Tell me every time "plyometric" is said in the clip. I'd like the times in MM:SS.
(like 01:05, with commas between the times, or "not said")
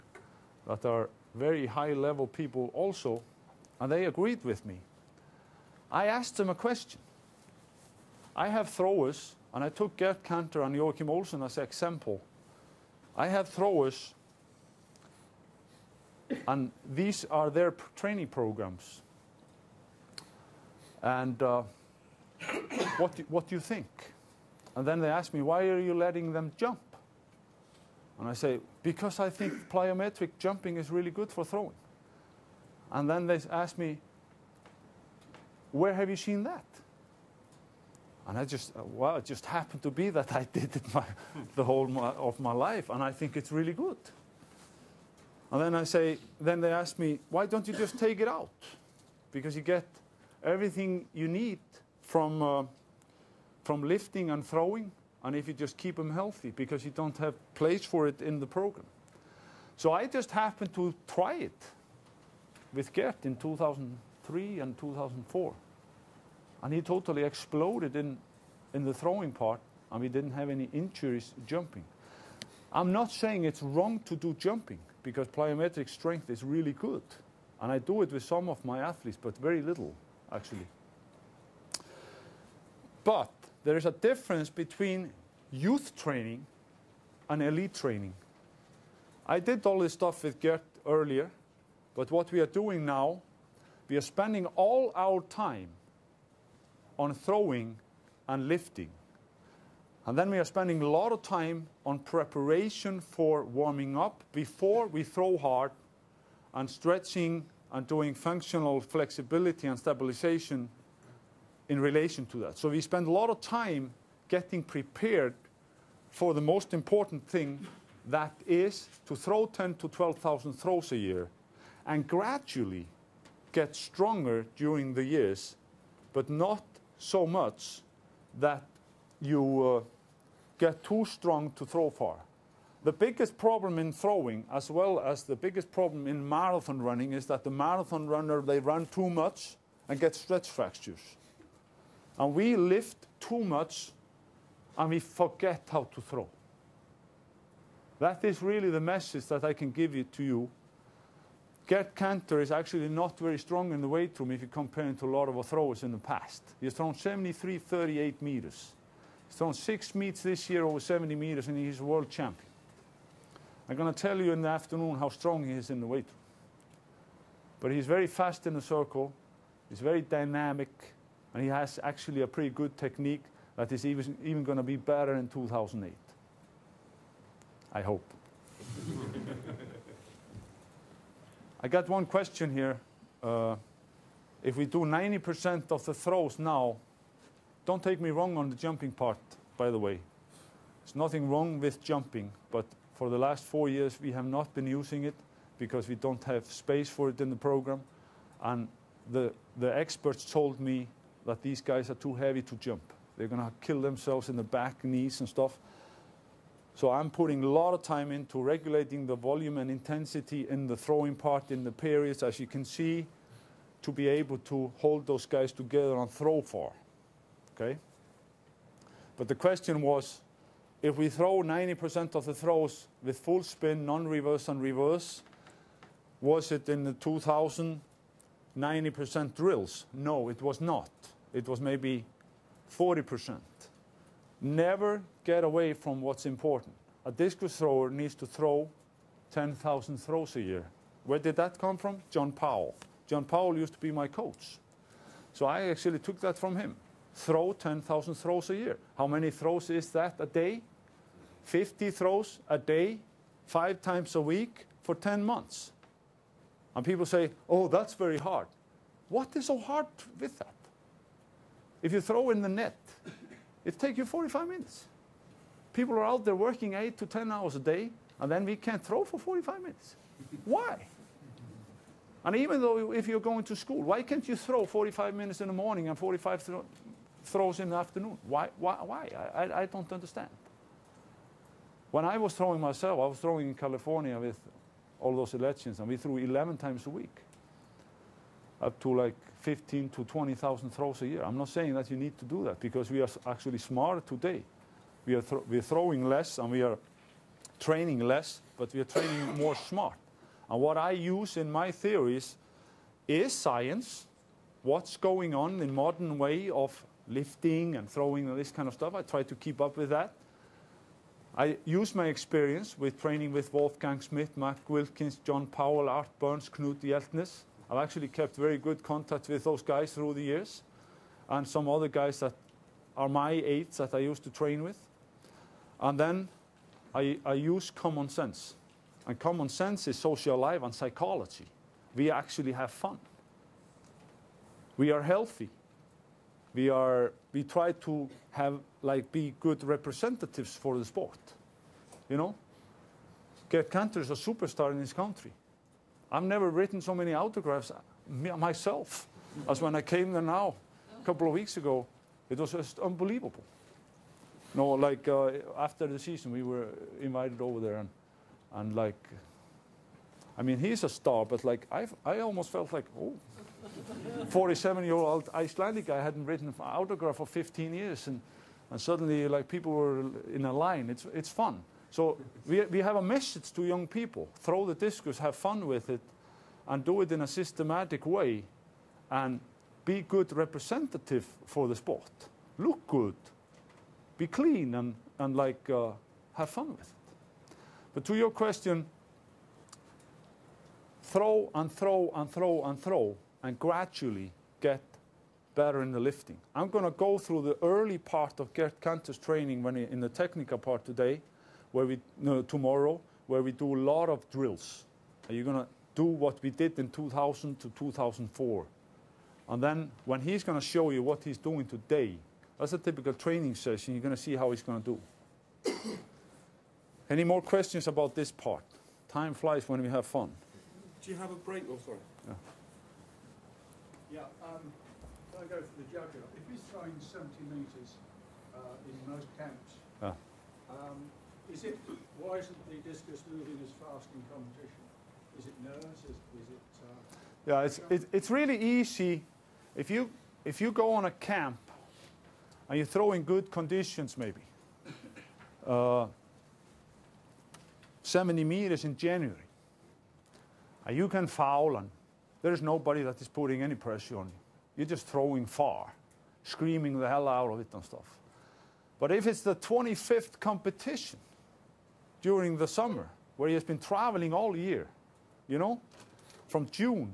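00:29, 01:15.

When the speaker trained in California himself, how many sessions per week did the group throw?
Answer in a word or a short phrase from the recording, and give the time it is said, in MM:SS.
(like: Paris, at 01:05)
11, at 04:46.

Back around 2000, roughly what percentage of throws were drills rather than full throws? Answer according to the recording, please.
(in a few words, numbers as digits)
40%.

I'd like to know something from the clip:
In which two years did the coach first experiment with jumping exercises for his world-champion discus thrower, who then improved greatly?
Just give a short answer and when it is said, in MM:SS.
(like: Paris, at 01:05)
2003 and 2004, at 01:03.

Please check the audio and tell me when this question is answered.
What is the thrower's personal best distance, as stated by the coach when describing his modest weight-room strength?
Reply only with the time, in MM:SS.
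02:36.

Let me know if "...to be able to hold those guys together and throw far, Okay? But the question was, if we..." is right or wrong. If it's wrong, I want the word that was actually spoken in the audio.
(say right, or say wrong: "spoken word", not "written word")
right.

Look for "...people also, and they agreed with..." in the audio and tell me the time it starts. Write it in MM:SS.
00:02.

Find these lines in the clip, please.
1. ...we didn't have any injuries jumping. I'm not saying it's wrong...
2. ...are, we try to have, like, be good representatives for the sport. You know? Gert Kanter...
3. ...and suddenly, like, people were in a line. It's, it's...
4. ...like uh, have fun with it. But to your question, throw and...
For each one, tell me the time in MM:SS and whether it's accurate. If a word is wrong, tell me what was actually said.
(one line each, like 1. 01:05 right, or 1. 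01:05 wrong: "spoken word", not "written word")
1. 01:10 right
2. 05:36 right
3. 06:08 right
4. 06:25 right.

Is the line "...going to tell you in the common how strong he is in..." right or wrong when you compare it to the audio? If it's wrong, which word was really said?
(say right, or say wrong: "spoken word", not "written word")
wrong: "afternoon", not "common".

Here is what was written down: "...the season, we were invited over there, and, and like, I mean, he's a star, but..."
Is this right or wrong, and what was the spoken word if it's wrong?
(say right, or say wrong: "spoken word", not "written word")
right.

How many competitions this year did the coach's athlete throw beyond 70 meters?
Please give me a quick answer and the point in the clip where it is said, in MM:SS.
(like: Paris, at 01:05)
6, at 02:39.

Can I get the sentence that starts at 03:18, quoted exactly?
And the, the experts told me that these guys are too heavy to jump.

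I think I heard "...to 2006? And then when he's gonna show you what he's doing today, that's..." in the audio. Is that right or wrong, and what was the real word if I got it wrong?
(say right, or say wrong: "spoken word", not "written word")
wrong: "2004", not "2006".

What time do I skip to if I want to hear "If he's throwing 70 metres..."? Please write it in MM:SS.
07:06.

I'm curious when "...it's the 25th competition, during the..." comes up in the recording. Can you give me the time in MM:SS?
07:39.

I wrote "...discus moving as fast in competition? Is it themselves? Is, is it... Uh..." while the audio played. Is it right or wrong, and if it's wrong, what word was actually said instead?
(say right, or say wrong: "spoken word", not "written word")
wrong: "nerves", not "themselves".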